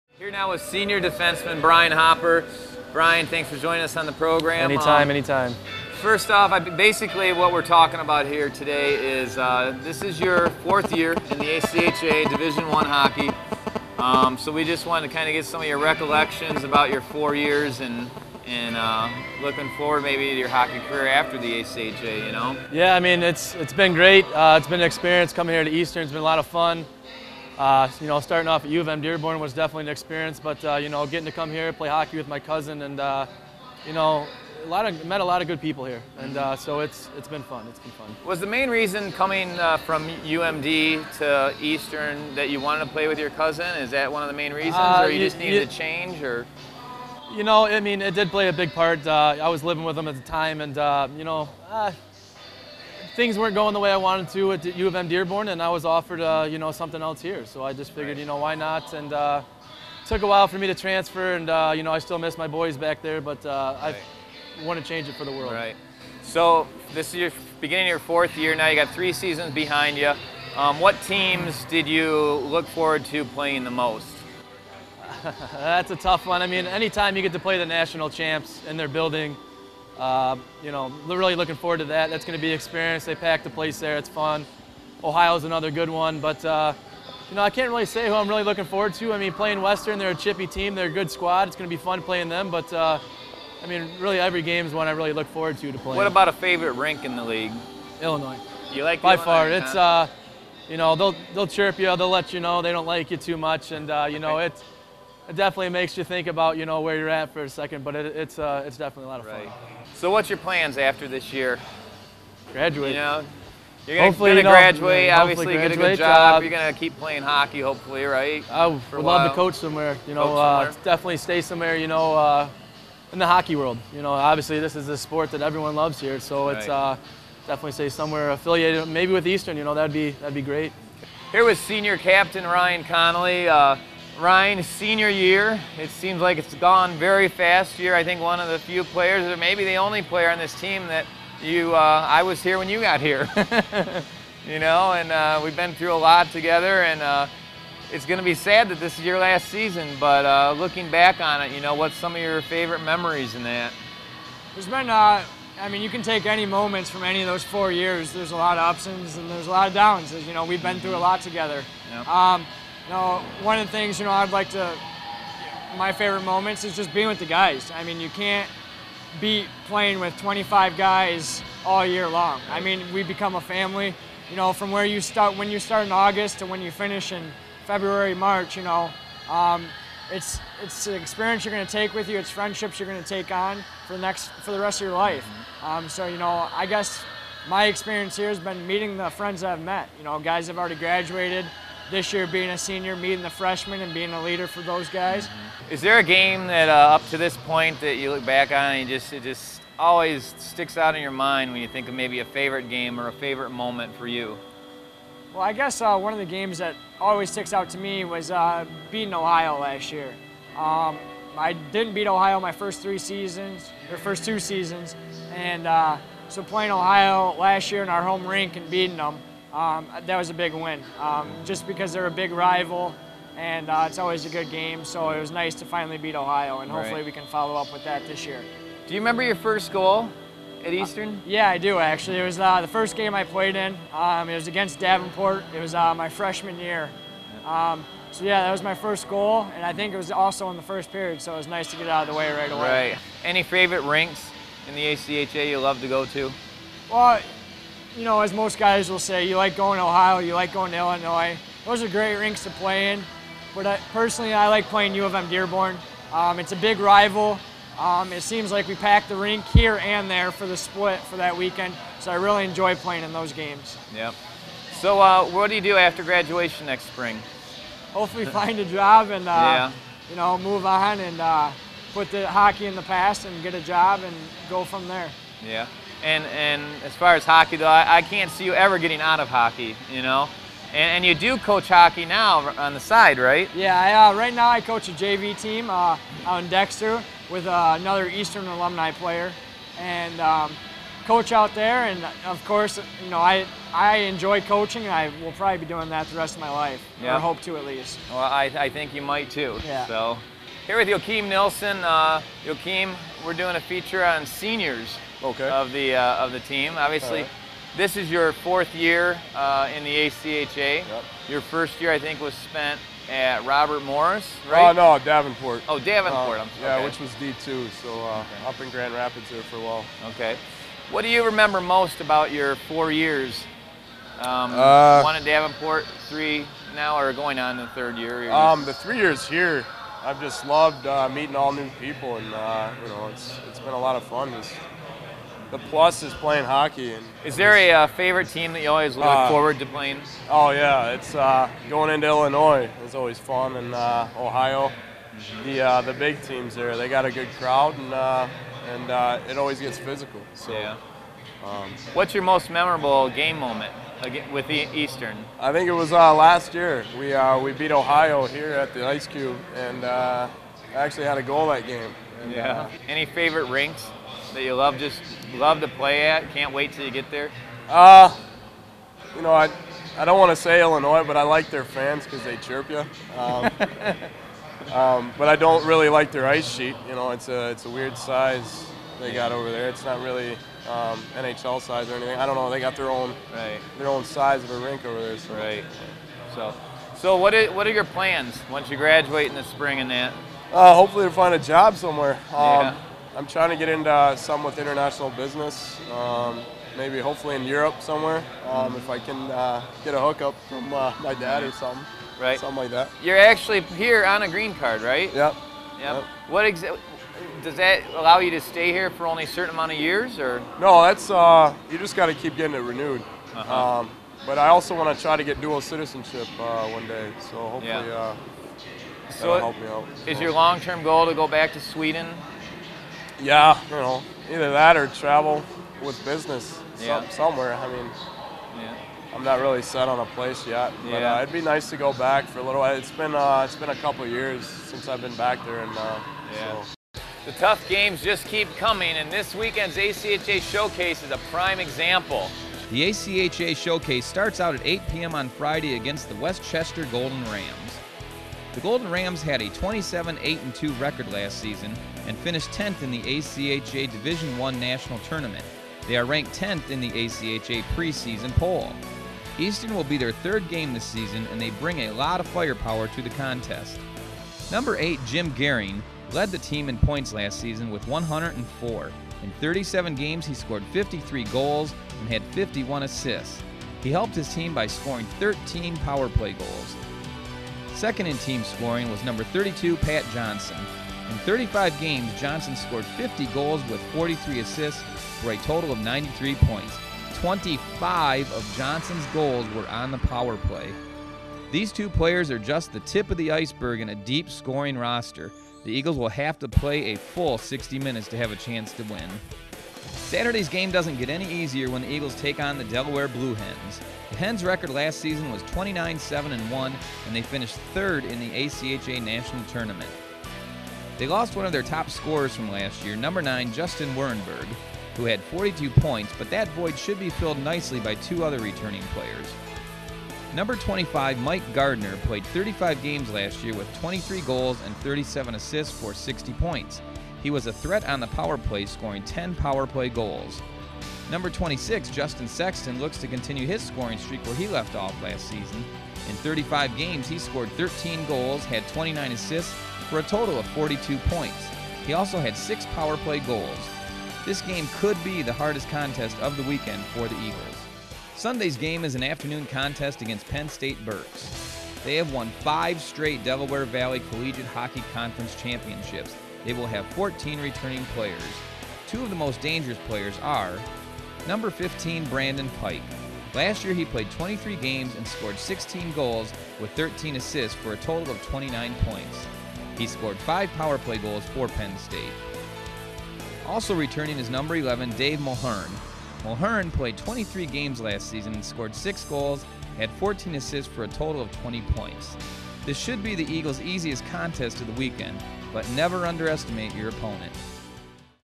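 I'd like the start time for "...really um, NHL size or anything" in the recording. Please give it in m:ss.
6:20.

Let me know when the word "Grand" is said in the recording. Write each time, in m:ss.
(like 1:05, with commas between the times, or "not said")
5:18.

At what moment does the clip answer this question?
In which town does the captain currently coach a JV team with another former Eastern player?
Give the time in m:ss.
4:46.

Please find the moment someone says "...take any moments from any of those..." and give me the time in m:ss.
2:36.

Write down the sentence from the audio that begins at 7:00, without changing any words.
Is your long-term goal to go back to Sweden yeah, you know, either that or travel with business yeah.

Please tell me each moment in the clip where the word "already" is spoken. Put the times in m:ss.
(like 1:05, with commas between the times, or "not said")
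3:10.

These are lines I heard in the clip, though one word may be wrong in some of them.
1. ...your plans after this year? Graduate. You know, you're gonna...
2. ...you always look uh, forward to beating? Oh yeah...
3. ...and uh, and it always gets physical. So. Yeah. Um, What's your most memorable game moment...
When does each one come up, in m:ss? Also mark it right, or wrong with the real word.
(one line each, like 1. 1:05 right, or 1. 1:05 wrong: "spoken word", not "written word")
1. 1:50 right
2. 5:38 wrong: "playing", not "beating"
3. 5:47 right.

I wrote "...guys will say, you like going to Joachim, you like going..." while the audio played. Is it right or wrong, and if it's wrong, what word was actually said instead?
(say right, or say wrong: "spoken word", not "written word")
wrong: "Ohio", not "Joachim".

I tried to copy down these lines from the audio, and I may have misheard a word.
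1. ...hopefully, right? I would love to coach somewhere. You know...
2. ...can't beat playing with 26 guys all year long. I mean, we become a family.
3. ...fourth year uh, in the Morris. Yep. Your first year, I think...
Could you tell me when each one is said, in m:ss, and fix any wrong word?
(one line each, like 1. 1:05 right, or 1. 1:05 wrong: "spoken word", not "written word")
1. 1:57 right
2. 2:48 wrong: "25", not "26"
3. 5:08 wrong: "ACHA", not "Morris".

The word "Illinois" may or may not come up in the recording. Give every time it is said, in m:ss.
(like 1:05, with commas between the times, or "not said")
1:38, 4:10, 5:42, 6:10.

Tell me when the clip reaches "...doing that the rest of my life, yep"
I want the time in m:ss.
4:55.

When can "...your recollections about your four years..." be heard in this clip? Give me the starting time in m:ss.
0:15.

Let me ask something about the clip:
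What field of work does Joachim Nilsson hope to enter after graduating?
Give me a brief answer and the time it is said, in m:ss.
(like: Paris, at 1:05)
international business, at 6:34.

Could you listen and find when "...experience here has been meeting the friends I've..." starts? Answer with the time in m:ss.
3:07.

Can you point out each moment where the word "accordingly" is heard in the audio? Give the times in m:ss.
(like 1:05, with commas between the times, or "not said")
not said.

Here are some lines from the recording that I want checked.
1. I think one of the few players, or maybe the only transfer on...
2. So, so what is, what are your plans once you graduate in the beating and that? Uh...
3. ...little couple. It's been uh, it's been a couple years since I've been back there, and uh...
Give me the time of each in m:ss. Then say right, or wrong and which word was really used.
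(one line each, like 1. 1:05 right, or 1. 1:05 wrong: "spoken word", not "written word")
1. 2:17 wrong: "player", not "transfer"
2. 6:26 wrong: "spring", not "beating"
3. 7:12 wrong: "while", not "couple".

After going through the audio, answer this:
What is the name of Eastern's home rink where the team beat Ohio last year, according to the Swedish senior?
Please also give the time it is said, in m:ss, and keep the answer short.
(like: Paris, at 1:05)
Ice Cube, at 5:58.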